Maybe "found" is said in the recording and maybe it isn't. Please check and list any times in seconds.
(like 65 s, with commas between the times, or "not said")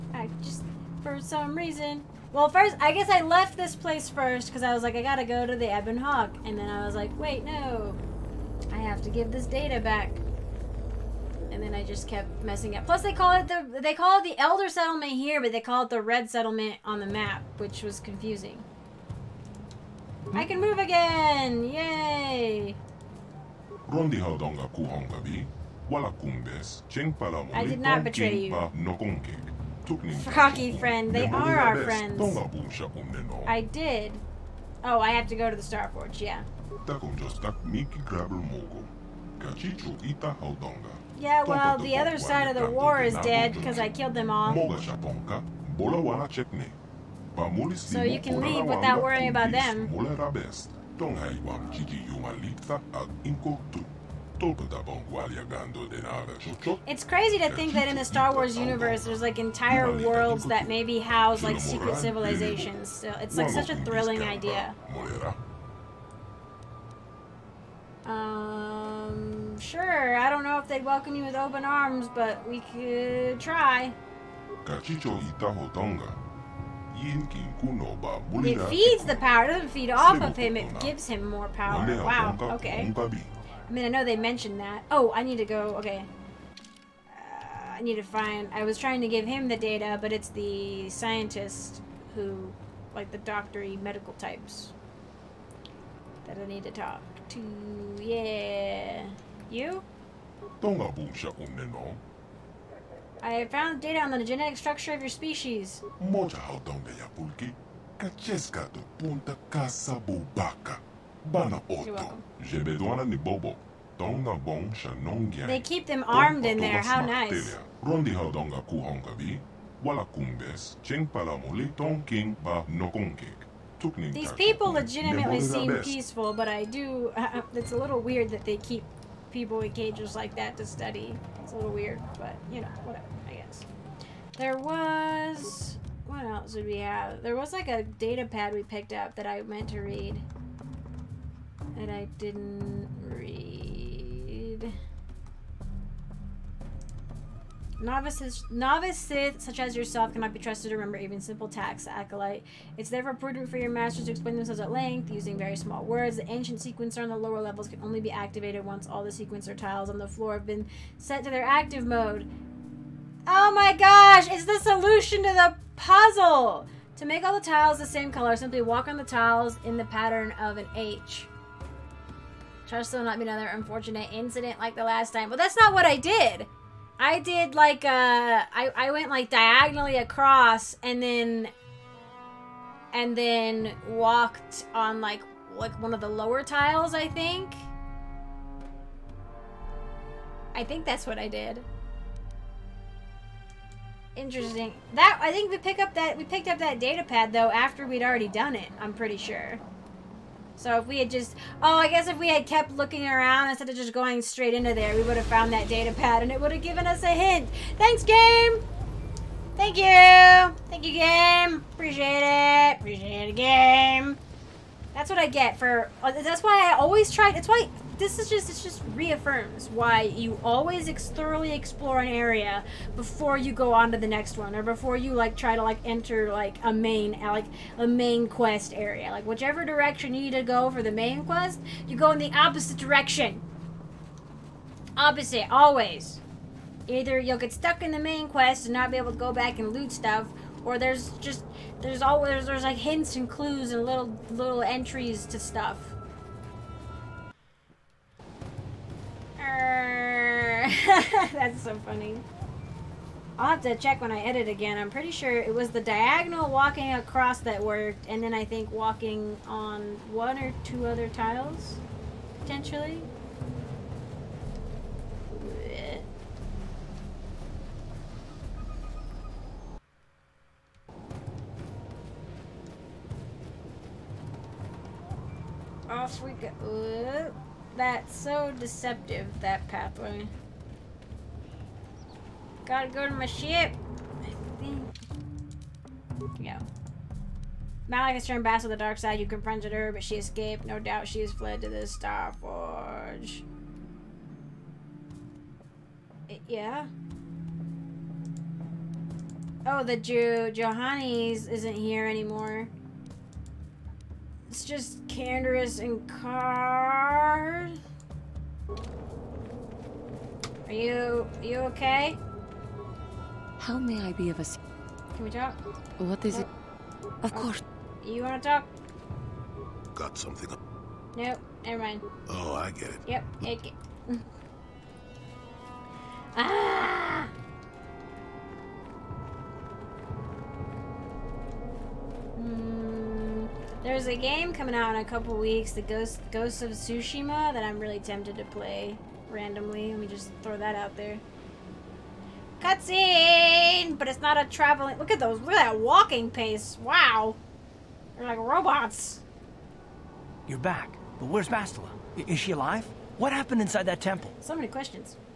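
103 s, 205 s.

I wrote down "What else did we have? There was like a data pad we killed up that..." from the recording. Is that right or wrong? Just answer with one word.
wrong.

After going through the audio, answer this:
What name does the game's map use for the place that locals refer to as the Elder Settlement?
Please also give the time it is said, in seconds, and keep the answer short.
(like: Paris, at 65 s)
Red Settlement, at 15 s.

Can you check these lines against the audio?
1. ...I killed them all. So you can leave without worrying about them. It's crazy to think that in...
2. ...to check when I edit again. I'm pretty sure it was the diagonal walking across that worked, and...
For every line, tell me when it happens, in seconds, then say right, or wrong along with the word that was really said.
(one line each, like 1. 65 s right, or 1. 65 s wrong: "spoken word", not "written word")
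1. 43 s right
2. 253 s right.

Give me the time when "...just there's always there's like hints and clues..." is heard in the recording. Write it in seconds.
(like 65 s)
241 s.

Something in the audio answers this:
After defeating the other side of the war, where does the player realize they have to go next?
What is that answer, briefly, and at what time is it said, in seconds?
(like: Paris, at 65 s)
The Forge, at 35 s.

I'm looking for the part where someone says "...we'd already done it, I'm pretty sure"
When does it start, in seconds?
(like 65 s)
197 s.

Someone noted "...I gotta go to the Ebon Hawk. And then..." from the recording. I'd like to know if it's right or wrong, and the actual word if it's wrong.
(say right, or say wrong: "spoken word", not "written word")
right.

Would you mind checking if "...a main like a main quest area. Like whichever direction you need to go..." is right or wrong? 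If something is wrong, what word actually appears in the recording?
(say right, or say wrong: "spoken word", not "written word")
right.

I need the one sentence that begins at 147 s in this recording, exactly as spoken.
Novices, novice Sith, such as yourself, cannot be trusted to remember even simple tasks, acolyte.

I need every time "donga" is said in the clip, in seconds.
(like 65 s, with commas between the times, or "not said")
24 s, 113 s.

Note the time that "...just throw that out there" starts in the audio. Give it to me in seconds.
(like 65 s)
340 s.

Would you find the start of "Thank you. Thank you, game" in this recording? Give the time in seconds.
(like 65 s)
209 s.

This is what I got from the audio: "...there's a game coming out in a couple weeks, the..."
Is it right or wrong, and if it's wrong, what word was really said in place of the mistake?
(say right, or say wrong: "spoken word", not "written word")
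right.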